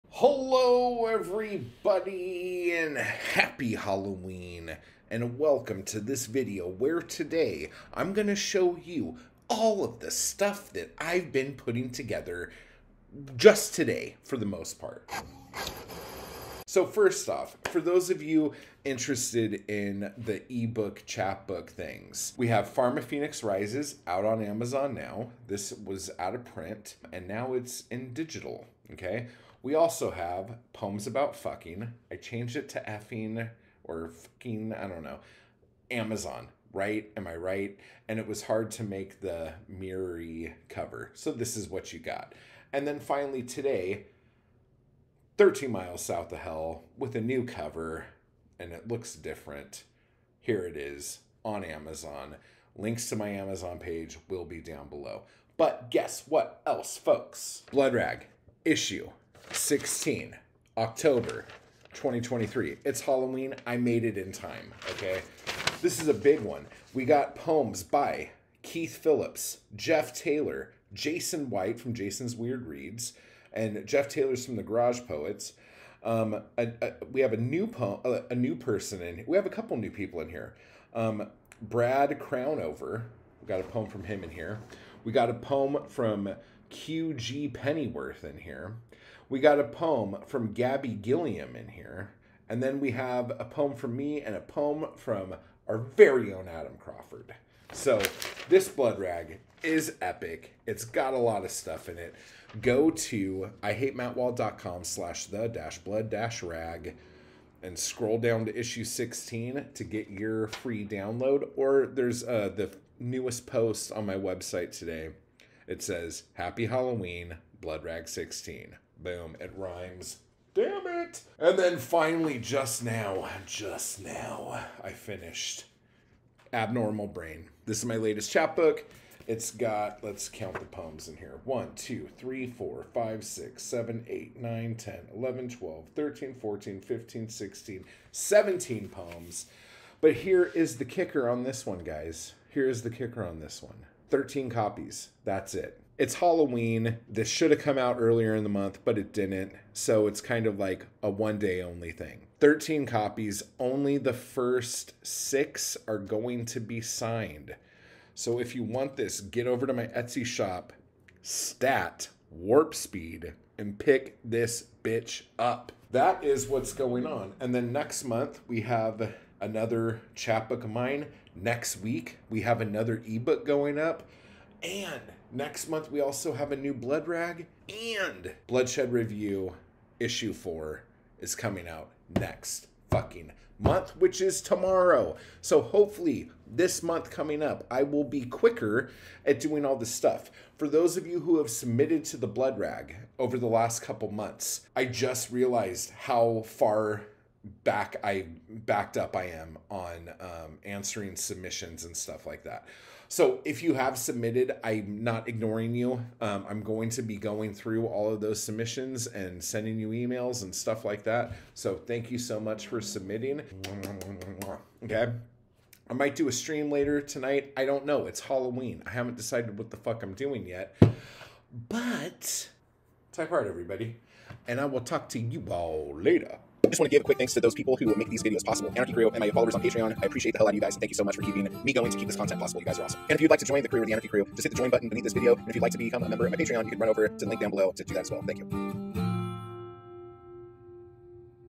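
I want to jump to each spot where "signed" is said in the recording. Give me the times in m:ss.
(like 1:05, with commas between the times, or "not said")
2:36.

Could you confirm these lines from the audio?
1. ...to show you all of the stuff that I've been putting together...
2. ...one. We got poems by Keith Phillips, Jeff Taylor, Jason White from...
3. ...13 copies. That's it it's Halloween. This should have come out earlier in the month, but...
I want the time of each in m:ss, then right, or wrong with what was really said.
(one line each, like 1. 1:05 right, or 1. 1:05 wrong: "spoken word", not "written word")
1. 0:08 right
2. 1:06 right
3. 2:24 right.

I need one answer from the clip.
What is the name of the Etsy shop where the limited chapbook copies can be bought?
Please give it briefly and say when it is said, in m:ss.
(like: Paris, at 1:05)
Stat Warp Speed, at 2:41.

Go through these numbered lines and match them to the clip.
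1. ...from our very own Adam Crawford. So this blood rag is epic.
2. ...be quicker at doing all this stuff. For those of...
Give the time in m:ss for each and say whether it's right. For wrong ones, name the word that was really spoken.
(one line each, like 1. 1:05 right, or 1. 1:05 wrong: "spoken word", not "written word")
1. 1:34 right
2. 3:08 right.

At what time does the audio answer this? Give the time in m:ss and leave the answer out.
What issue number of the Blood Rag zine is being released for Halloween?
0:57.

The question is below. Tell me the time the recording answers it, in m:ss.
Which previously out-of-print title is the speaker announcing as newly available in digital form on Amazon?
0:22.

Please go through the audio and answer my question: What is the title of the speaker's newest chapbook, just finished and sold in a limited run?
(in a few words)
Abnormal Brain.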